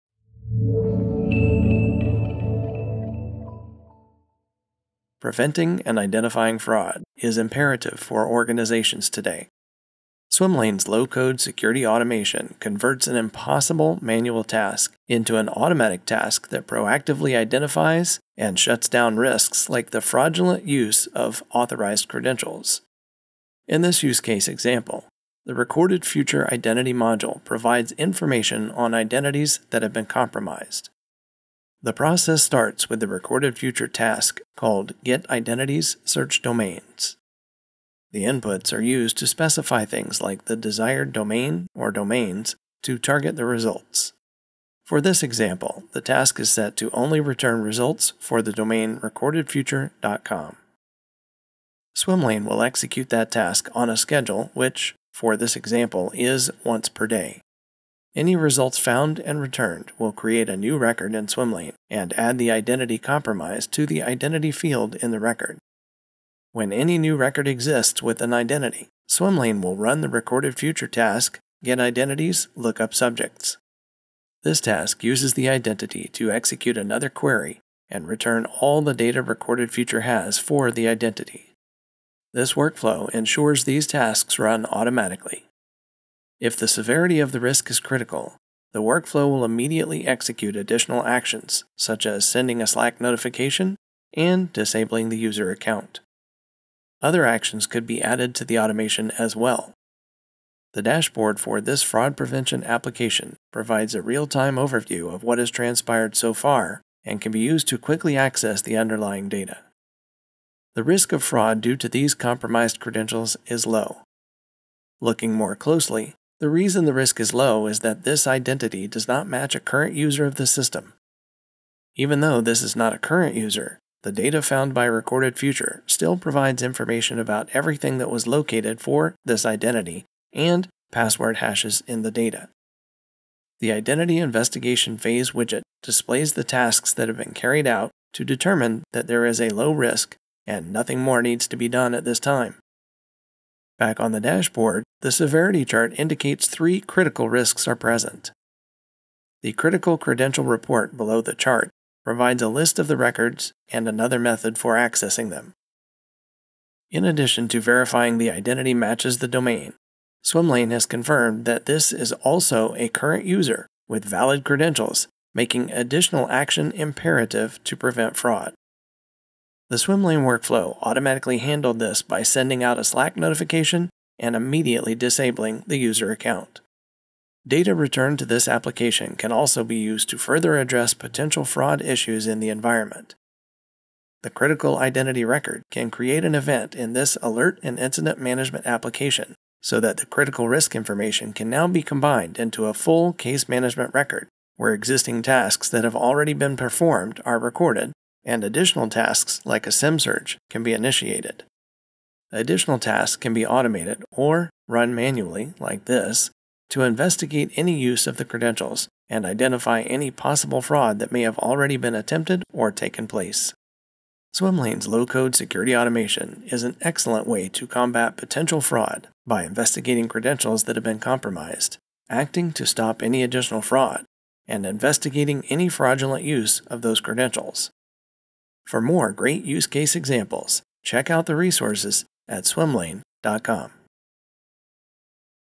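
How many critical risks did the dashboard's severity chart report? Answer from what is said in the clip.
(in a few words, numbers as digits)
3.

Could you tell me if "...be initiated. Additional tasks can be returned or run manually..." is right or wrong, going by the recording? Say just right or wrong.
wrong.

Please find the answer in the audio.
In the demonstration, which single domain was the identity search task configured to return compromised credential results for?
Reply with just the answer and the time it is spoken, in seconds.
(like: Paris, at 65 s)
recordedfuture.com, at 49 s.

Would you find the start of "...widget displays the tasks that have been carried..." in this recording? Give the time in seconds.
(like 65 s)
135 s.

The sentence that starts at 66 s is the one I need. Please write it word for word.
When any new record exists with an identity, Swimlane will run the recorded future task, get identities, look up subjects.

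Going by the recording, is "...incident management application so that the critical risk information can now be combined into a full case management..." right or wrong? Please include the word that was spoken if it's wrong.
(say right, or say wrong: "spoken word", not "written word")
right.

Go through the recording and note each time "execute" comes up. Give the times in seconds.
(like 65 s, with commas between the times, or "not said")
52 s, 76 s, 90 s.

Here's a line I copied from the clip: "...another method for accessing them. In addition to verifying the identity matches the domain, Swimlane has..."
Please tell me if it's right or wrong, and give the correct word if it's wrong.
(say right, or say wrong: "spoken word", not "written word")
right.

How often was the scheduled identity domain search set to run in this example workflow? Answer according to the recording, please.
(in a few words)
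once per day.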